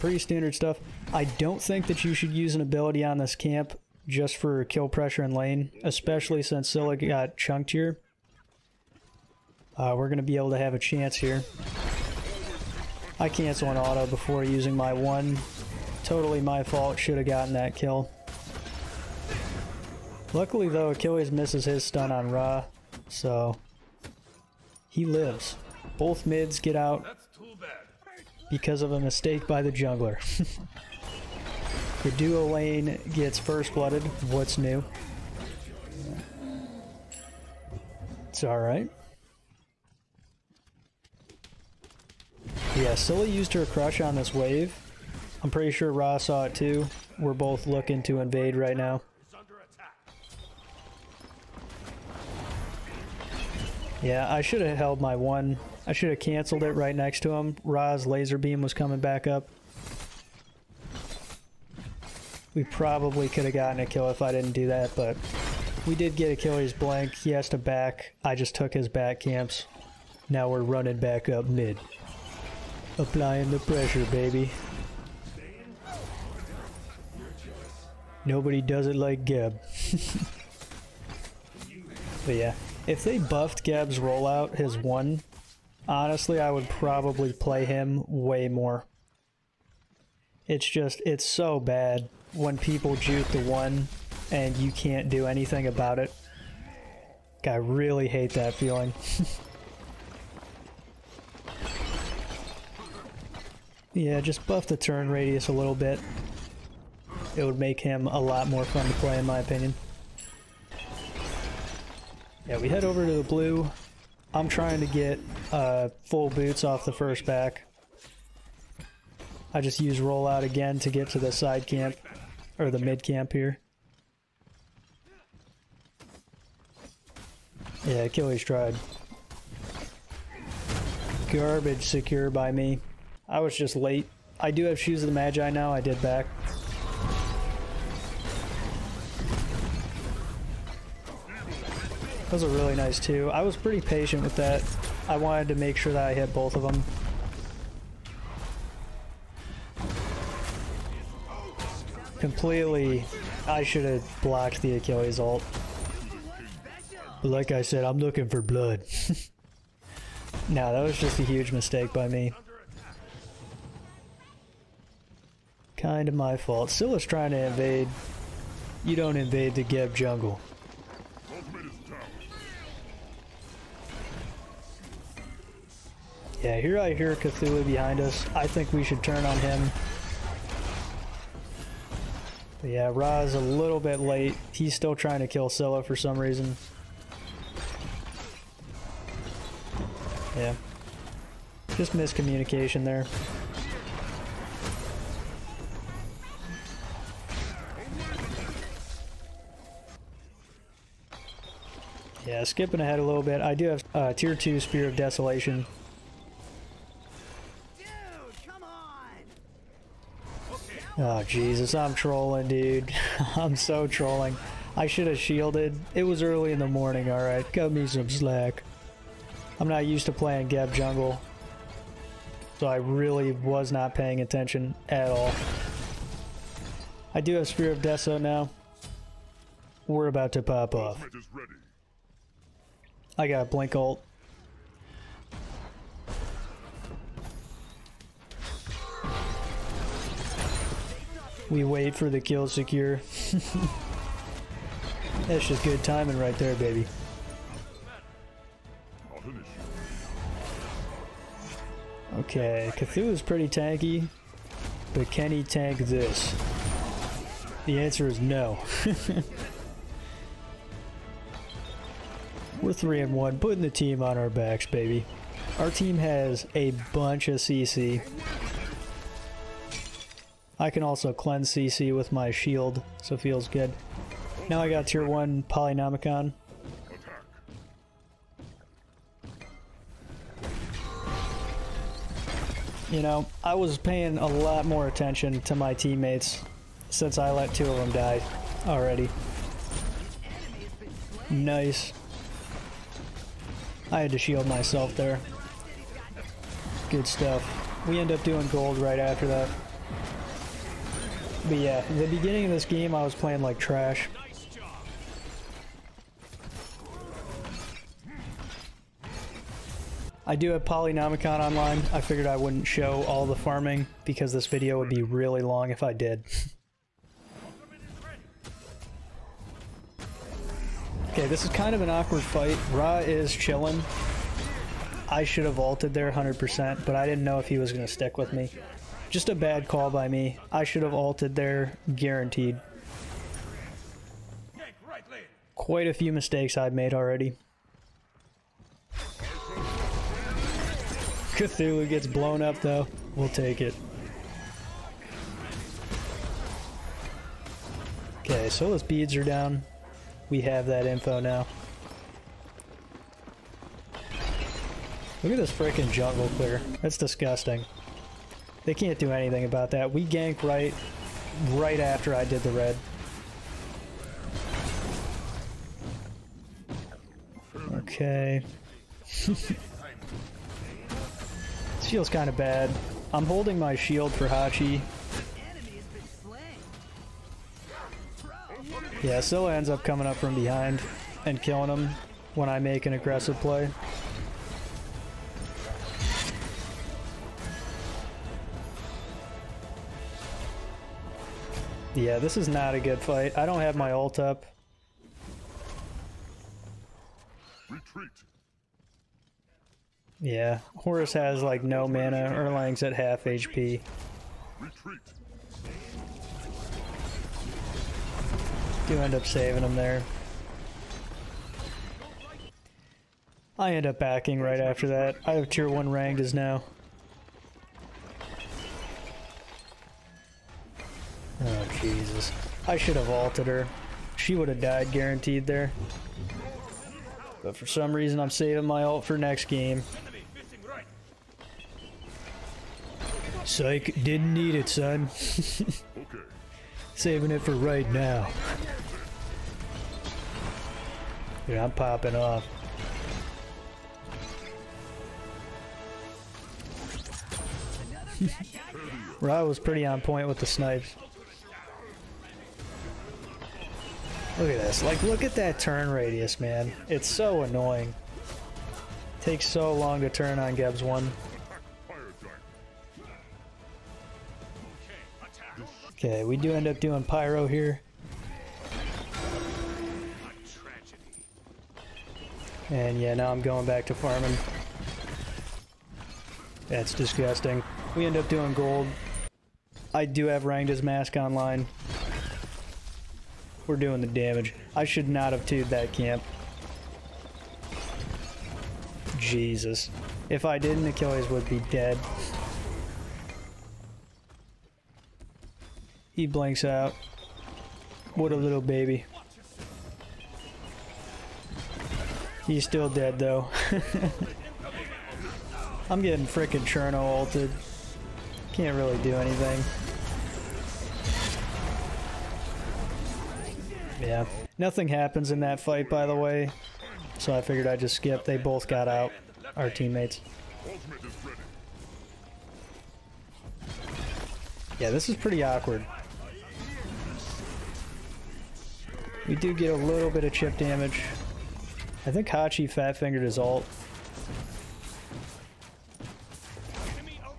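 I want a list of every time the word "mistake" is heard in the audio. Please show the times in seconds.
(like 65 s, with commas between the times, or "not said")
28 s, 161 s, 336 s.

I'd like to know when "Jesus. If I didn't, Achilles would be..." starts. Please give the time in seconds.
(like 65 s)
489 s.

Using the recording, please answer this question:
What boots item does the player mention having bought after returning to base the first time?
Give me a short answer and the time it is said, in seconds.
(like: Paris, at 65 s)
Shoes of the Magi, at 134 s.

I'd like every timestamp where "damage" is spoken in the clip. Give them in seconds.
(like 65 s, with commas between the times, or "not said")
484 s, 530 s.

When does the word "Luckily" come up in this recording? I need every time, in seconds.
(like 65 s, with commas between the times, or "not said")
20 s.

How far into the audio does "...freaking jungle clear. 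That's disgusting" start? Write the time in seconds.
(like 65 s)
355 s.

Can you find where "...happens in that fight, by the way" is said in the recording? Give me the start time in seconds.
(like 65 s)
514 s.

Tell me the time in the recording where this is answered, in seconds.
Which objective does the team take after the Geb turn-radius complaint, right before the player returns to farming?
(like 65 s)
467 s.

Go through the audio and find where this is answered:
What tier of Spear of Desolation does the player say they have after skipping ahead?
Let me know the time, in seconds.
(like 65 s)
204 s.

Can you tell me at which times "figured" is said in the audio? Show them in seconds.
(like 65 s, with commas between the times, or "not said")
312 s, 517 s.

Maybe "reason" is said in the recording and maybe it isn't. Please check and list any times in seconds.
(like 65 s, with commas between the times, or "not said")
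186 s, 427 s.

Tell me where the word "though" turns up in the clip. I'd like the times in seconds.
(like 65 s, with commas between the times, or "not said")
20 s, 342 s, 503 s.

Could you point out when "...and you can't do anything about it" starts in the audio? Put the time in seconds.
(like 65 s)
94 s.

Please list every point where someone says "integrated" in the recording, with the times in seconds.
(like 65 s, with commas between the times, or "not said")
not said.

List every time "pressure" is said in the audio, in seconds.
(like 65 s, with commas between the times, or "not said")
4 s, 73 s.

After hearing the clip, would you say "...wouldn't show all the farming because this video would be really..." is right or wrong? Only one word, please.
right.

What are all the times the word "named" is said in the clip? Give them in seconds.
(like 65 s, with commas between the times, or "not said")
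not said.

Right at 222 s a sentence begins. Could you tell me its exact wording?
So I really was not paying attention at all.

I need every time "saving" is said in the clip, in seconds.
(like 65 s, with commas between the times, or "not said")
409 s, 428 s, 436 s.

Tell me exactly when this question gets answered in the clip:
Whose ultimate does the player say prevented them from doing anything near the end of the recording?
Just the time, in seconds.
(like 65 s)
506 s.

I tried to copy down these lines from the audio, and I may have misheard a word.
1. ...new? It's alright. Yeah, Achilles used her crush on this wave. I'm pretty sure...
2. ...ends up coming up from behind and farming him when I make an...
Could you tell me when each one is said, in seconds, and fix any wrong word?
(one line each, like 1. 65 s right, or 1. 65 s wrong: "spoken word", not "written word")
1. 34 s wrong: "Scylla", not "Achilles"
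2. 379 s wrong: "killing", not "farming".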